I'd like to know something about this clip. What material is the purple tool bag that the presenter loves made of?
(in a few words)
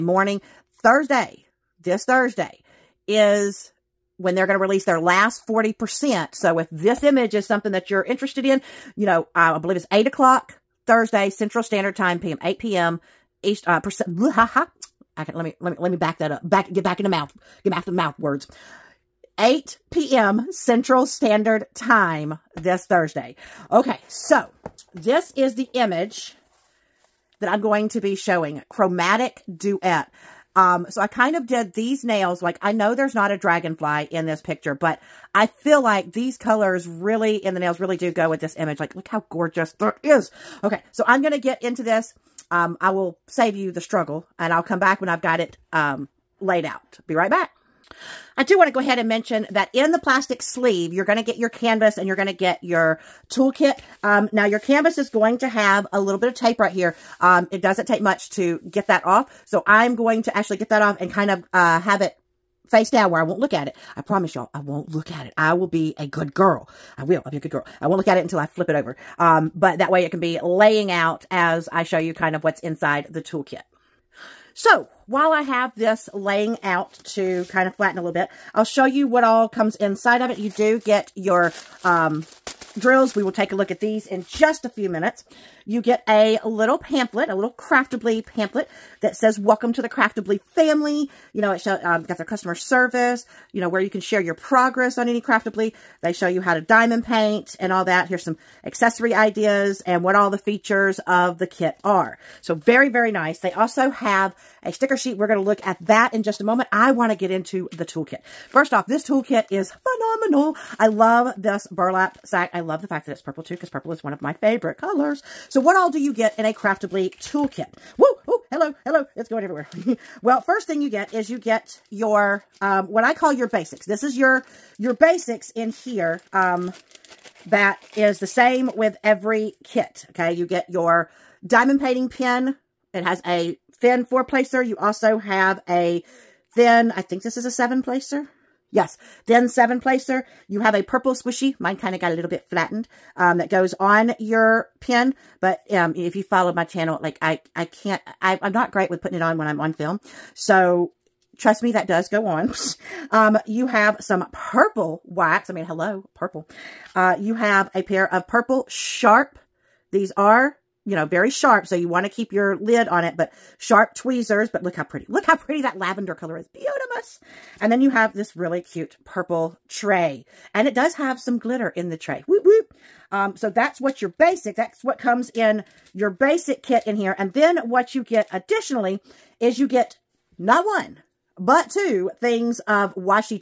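burlap.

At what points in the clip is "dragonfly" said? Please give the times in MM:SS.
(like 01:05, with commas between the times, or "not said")
00:33.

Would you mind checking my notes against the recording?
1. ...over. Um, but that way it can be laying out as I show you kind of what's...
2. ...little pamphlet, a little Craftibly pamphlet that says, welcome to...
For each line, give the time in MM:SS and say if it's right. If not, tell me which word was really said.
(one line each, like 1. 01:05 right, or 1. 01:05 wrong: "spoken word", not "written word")
1. 01:08 right
2. 01:26 right.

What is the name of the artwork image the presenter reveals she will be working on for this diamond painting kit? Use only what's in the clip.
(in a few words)
Chromatic Duet.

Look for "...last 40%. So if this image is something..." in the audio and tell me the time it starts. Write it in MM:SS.
00:04.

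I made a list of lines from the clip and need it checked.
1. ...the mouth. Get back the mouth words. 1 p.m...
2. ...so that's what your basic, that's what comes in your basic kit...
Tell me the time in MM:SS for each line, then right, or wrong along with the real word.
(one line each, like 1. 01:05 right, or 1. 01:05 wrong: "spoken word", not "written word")
1. 00:17 wrong: "8", not "1"
2. 02:53 right.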